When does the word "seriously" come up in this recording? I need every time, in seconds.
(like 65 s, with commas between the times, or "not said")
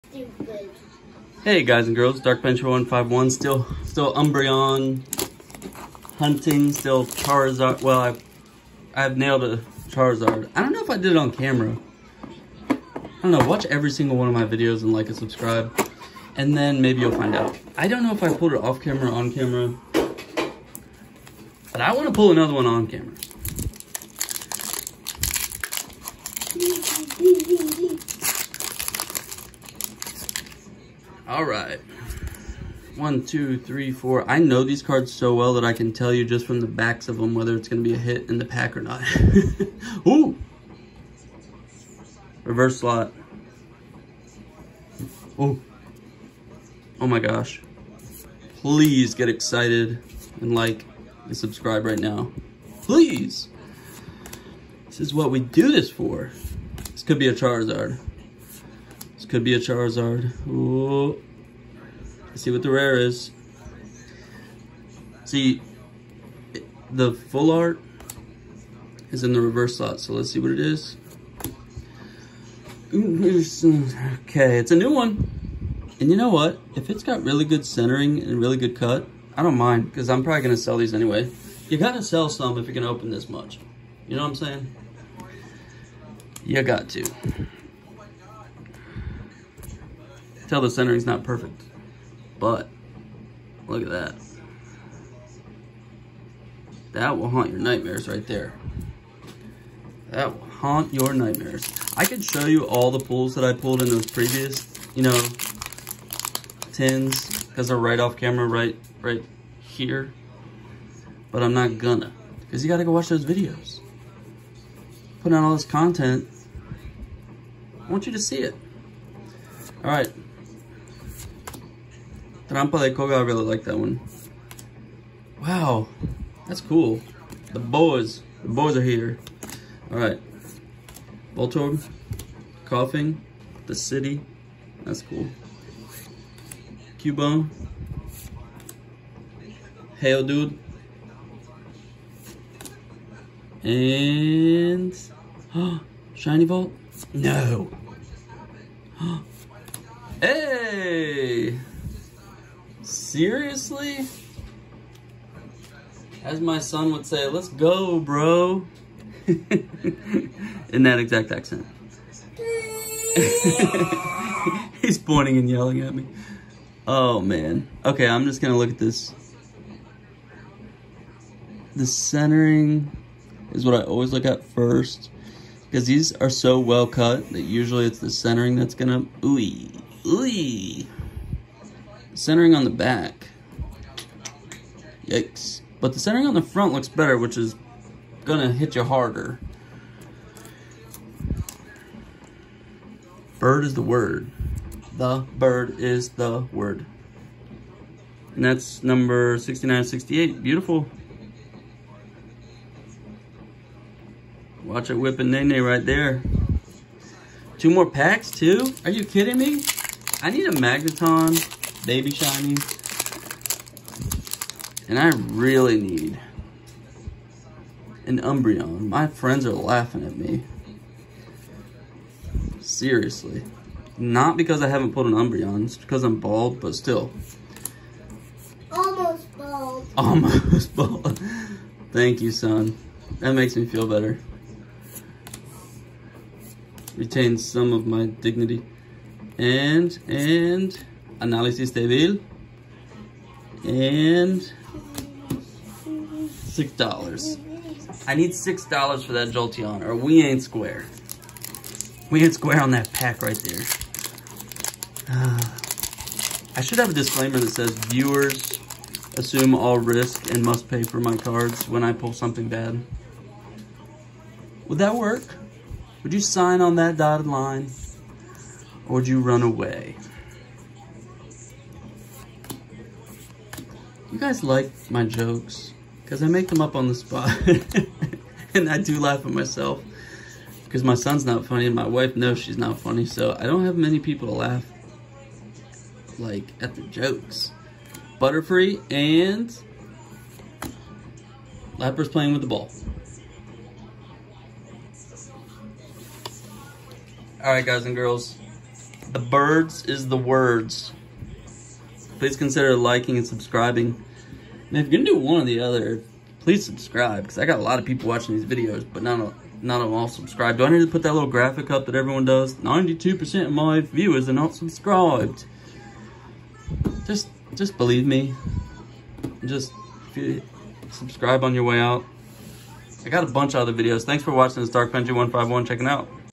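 153 s, 222 s.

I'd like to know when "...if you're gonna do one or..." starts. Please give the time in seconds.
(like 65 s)
304 s.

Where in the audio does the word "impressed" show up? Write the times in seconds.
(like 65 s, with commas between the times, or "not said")
not said.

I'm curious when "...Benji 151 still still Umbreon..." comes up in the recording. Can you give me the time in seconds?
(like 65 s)
2 s.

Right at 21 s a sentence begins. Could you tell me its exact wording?
But I want to pull another one on camera.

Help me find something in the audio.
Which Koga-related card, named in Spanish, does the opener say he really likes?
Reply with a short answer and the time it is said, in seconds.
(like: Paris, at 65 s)
Trampa de Koga, at 122 s.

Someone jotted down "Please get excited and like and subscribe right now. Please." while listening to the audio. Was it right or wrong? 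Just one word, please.
right.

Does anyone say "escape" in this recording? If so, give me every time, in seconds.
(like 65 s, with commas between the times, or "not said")
not said.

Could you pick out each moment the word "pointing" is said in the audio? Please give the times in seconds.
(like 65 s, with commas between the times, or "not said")
164 s.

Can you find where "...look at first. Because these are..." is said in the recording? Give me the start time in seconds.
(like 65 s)
174 s.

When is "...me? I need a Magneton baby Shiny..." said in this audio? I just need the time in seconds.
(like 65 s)
209 s.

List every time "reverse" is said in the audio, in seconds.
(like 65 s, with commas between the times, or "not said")
42 s, 69 s.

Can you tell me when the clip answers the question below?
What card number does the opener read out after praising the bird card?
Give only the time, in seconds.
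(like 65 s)
199 s.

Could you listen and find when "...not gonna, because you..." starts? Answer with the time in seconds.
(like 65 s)
111 s.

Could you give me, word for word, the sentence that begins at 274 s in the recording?
guys like my jokes, because I make them up on the spot.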